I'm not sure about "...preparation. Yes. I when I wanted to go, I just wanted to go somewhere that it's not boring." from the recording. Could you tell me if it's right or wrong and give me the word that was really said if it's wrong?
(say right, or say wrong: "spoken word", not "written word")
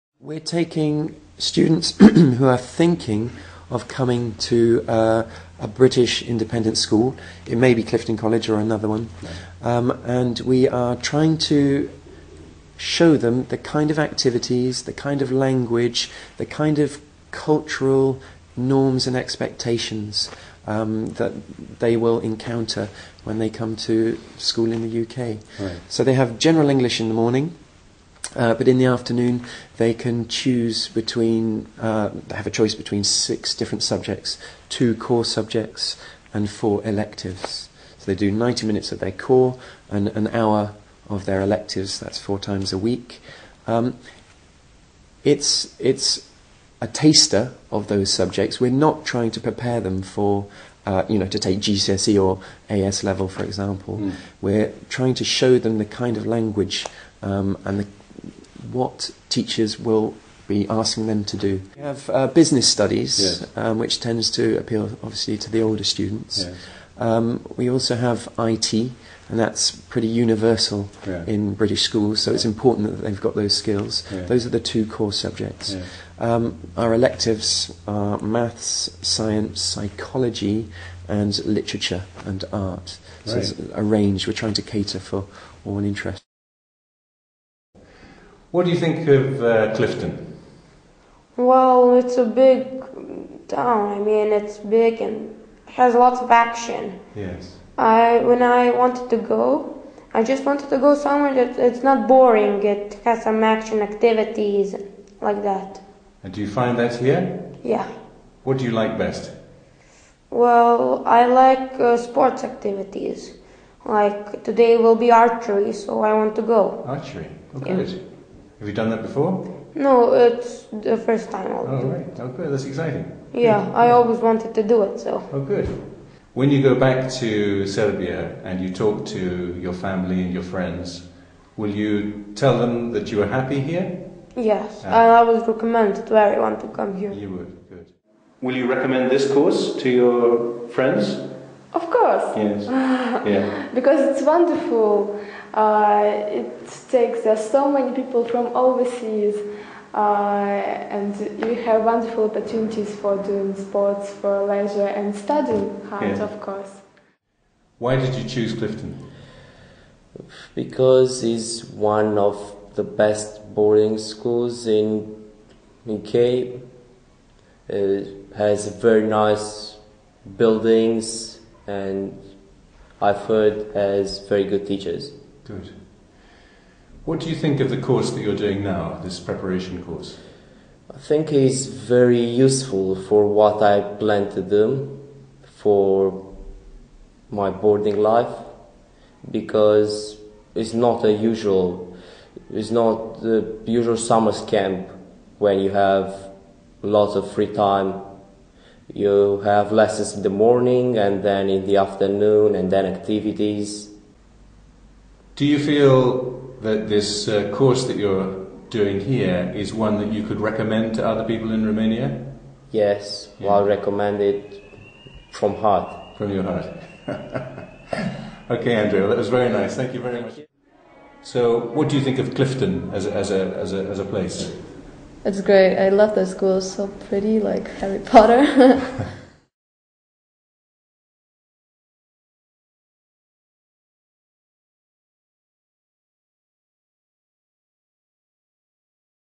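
wrong: "action", not "preparation".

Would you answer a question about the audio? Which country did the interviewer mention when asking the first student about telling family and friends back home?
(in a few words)
Serbia.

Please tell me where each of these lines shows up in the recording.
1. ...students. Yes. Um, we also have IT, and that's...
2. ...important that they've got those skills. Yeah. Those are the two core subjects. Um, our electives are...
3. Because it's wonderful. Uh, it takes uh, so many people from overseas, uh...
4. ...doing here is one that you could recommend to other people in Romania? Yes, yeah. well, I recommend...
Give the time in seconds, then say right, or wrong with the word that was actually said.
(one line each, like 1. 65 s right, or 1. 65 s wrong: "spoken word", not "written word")
1. 65 s right
2. 72 s right
3. 143 s right
4. 208 s right.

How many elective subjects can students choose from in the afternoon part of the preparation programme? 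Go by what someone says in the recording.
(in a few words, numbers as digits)
4.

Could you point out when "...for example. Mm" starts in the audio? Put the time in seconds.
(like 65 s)
53 s.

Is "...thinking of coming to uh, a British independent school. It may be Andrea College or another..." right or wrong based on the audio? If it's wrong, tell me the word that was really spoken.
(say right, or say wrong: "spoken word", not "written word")
wrong: "Clifton", not "Andrea".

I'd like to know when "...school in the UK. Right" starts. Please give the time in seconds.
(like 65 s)
24 s.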